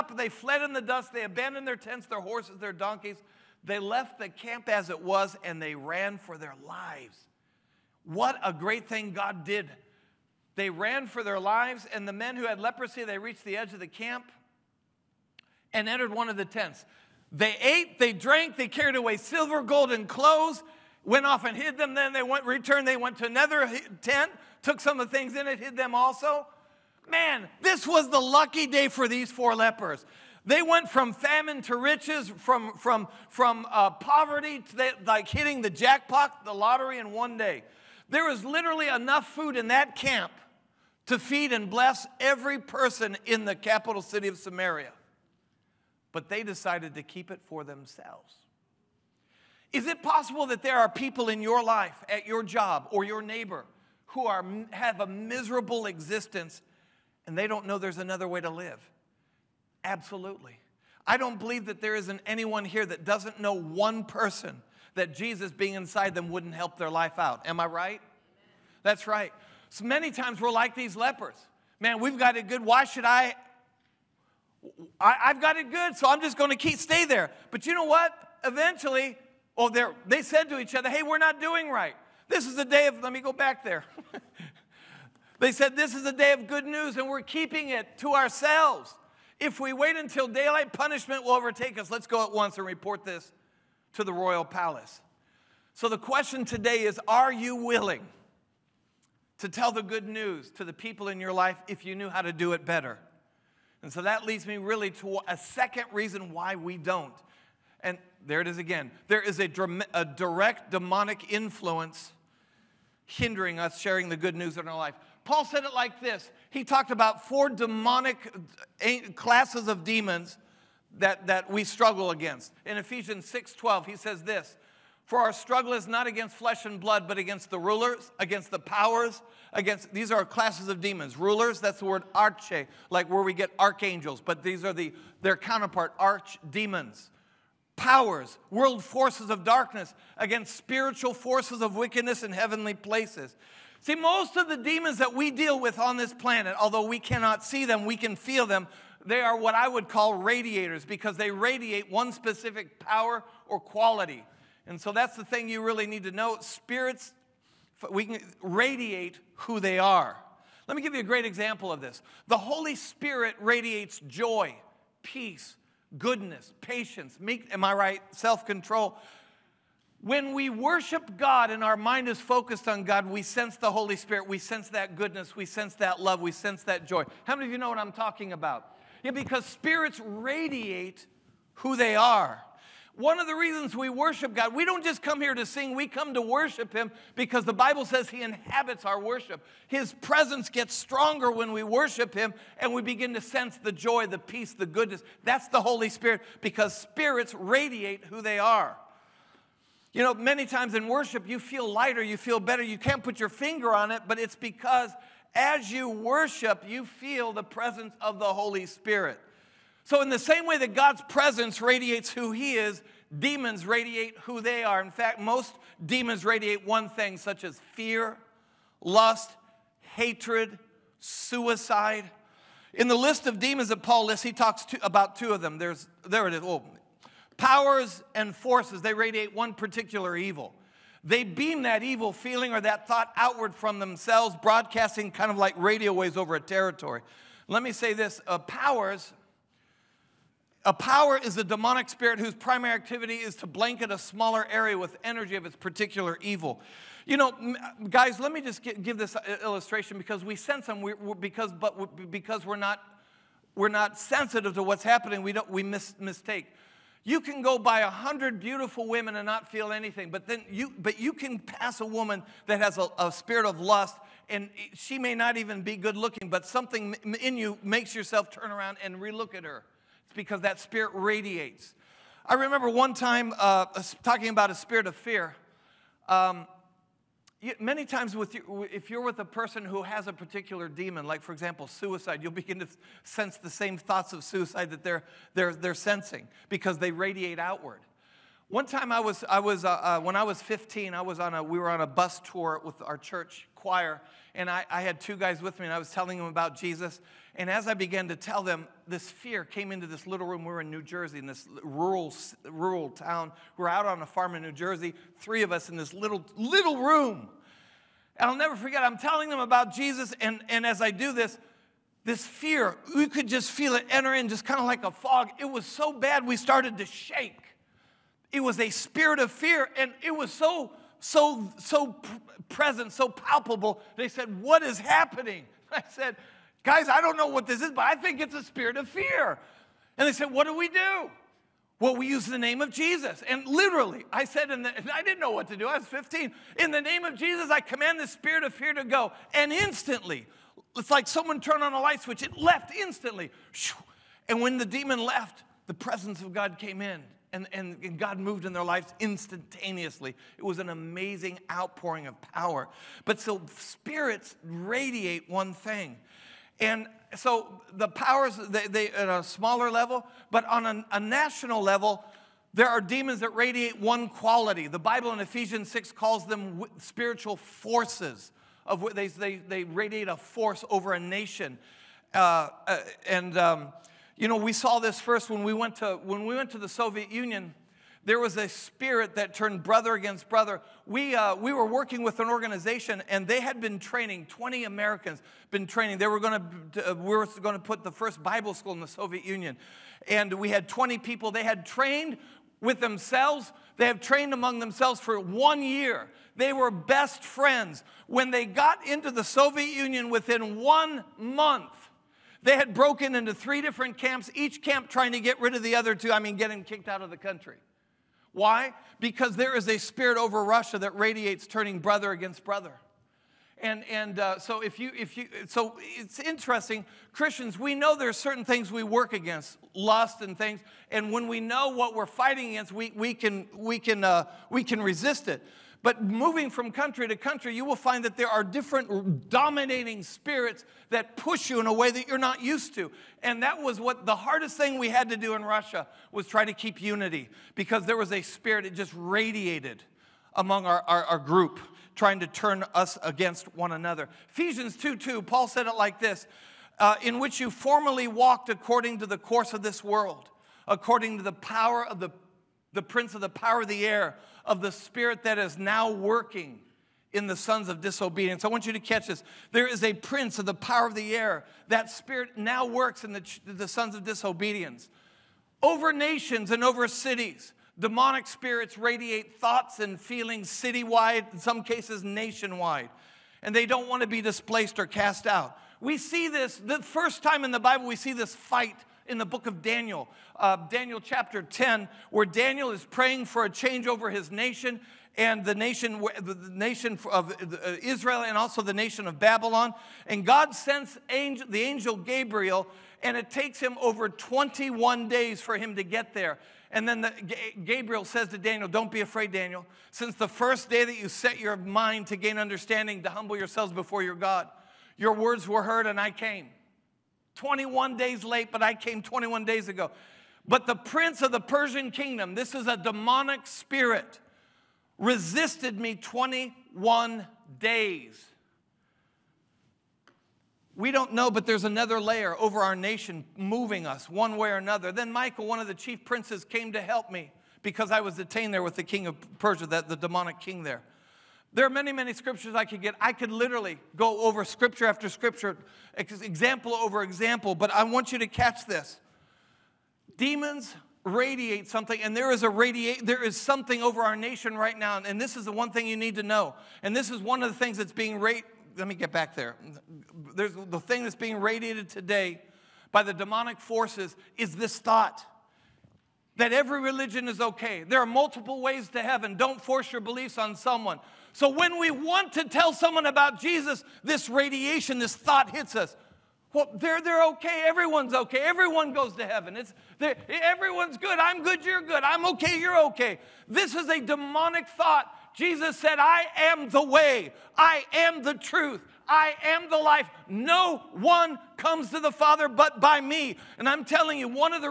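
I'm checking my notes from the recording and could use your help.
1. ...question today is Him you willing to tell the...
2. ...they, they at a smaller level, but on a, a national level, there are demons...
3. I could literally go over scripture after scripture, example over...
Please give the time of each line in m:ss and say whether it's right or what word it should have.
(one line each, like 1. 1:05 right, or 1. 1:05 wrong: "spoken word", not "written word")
1. 1:35 wrong: "Are", not "Him"
2. 5:58 right
3. 8:52 right.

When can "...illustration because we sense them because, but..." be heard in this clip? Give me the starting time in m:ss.
4:09.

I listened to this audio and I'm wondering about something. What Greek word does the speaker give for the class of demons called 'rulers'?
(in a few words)
arche.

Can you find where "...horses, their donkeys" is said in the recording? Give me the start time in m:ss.
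0:02.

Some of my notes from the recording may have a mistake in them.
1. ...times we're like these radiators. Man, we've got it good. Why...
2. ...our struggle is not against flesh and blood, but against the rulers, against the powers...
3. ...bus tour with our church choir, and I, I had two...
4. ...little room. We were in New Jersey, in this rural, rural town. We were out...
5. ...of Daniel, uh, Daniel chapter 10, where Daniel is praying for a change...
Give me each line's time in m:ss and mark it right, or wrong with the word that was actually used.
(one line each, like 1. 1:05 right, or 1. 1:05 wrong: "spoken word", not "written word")
1. 1:10 wrong: "lepers", not "radiators"
2. 2:05 right
3. 4:51 right
4. 5:00 right
5. 7:59 right.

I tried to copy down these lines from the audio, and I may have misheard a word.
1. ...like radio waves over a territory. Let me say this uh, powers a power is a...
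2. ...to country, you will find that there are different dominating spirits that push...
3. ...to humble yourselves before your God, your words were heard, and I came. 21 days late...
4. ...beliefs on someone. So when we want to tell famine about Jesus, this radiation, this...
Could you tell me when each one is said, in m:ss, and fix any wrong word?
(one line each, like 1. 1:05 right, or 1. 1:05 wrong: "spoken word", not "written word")
1. 3:55 right
2. 7:07 right
3. 8:23 right
4. 9:20 wrong: "someone", not "famine".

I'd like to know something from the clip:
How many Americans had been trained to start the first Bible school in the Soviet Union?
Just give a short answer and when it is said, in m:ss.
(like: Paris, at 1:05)
20, at 6:24.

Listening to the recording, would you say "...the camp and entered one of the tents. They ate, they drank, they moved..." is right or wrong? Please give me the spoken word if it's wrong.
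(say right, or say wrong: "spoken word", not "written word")
wrong: "carried", not "moved".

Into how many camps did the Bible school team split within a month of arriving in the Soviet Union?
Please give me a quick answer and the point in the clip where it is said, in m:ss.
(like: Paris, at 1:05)
3, at 6:43.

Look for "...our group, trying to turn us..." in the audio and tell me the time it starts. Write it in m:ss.
7:21.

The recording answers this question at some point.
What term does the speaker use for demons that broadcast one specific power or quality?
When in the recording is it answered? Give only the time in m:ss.
2:30.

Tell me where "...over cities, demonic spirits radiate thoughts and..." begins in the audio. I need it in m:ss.
7:46.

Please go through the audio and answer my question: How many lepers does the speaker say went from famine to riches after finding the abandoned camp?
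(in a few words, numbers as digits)
4.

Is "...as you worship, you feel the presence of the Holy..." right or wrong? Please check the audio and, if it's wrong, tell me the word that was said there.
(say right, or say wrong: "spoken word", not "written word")
right.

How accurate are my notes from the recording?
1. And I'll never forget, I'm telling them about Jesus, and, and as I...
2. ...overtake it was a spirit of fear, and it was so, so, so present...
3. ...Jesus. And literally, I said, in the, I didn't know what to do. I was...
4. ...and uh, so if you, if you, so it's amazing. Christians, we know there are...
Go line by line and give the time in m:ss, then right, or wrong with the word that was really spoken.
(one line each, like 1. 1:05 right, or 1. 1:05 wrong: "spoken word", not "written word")
1. 5:08 right
2. 5:16 wrong: "shake", not "overtake"
3. 5:32 right
4. 6:53 wrong: "interesting", not "amazing".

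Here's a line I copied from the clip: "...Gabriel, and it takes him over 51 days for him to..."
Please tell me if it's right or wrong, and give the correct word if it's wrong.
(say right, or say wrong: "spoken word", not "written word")
wrong: "21", not "51".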